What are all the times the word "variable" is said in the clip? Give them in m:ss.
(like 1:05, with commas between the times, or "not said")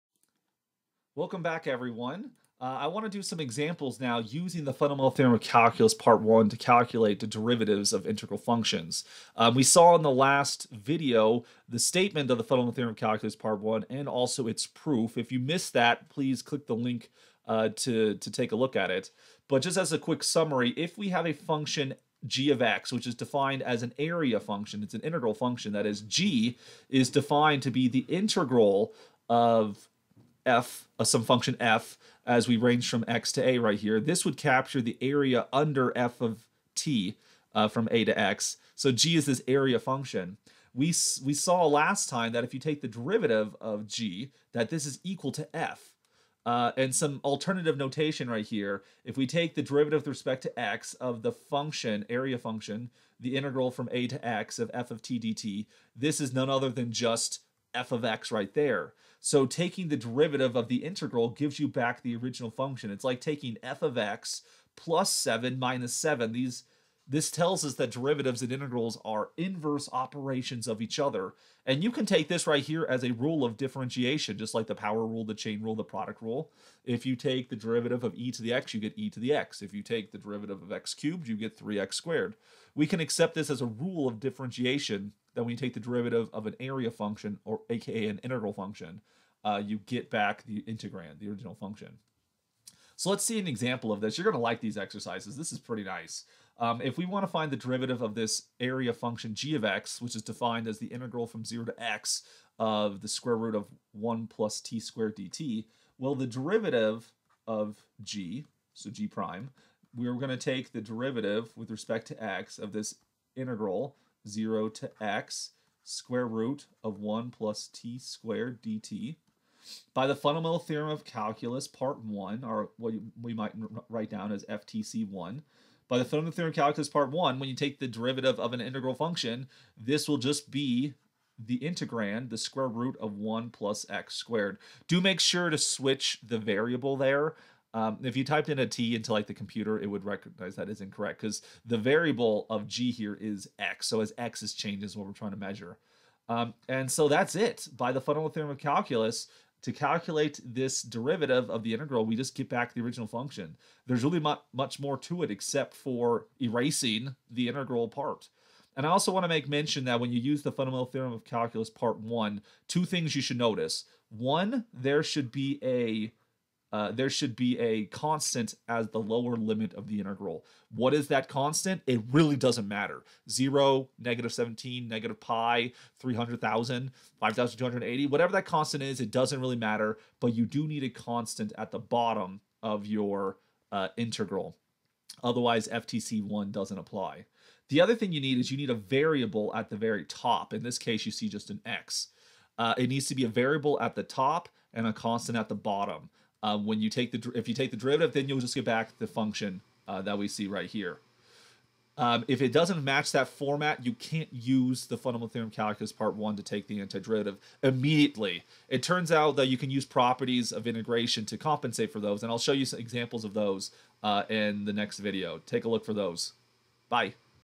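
2:16, 2:21, 3:08, 3:13.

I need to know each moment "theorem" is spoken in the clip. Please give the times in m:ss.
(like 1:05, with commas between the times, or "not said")
0:05, 0:12, 2:00, 2:06, 2:28, 2:40, 3:25.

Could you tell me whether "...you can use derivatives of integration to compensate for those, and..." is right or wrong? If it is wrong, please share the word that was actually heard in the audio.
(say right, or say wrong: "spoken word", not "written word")
wrong: "properties", not "derivatives".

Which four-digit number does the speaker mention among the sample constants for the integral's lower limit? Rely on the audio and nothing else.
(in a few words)
5,280.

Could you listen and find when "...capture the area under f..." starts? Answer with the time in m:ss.
0:34.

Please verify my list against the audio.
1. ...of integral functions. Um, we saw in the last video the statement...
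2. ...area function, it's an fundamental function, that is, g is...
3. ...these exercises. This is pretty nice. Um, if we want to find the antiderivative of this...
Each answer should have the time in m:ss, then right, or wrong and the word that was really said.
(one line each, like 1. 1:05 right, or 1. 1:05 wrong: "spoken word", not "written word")
1. 0:07 right
2. 0:23 wrong: "integral", not "fundamental"
3. 1:34 wrong: "derivative", not "antiderivative".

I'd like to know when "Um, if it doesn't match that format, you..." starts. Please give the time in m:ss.
3:21.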